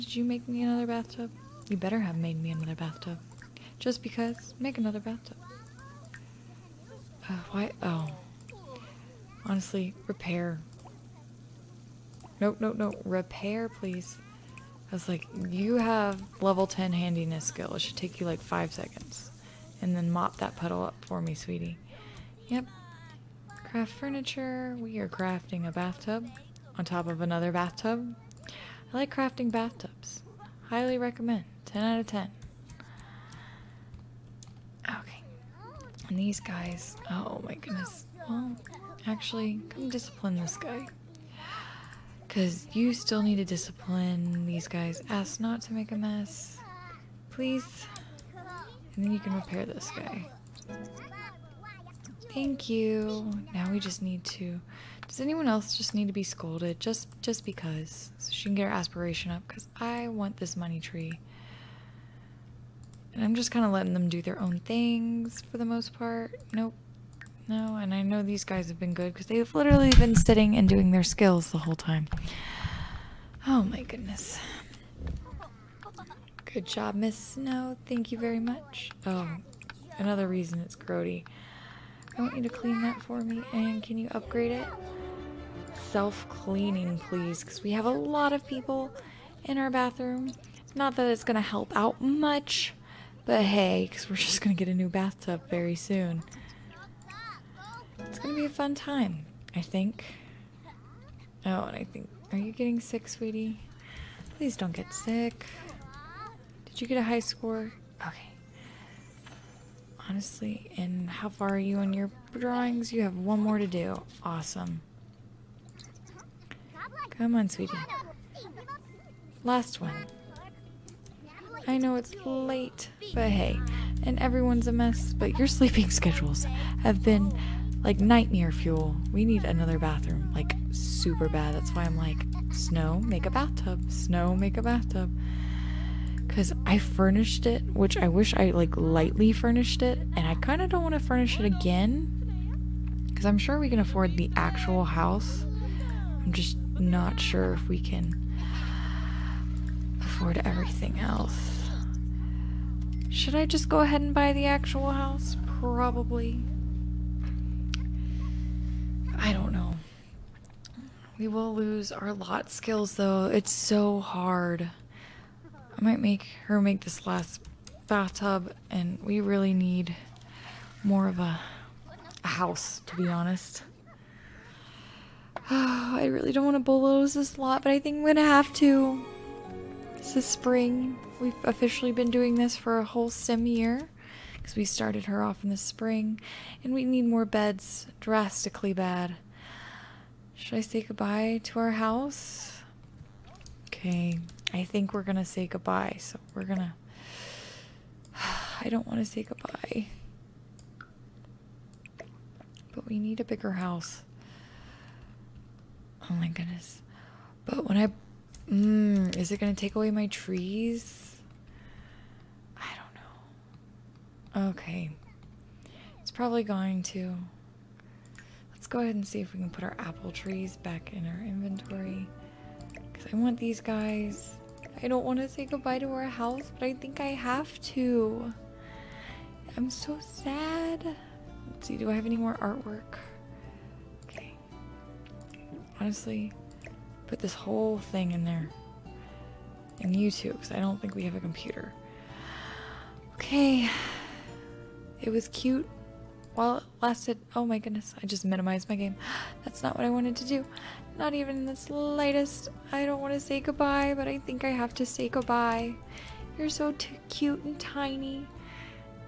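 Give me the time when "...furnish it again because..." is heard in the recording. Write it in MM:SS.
02:21.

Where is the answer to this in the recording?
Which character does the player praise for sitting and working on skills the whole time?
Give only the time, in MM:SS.
01:16.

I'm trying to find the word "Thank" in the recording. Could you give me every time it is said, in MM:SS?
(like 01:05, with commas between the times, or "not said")
00:52, 01:17.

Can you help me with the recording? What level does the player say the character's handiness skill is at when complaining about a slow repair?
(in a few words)
10.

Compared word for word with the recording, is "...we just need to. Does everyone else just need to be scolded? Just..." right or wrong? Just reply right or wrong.
wrong.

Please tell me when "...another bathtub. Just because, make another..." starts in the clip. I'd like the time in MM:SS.
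00:02.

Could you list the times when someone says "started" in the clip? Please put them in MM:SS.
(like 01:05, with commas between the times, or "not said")
03:04.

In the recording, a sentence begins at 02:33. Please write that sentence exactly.
Should I just go ahead and buy the actual house?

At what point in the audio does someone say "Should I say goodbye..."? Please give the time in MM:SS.
03:10.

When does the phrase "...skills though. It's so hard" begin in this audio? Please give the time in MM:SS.
02:42.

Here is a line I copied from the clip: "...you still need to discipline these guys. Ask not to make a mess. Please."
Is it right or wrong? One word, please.
right.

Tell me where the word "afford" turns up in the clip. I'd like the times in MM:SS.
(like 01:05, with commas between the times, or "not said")
02:23, 02:30.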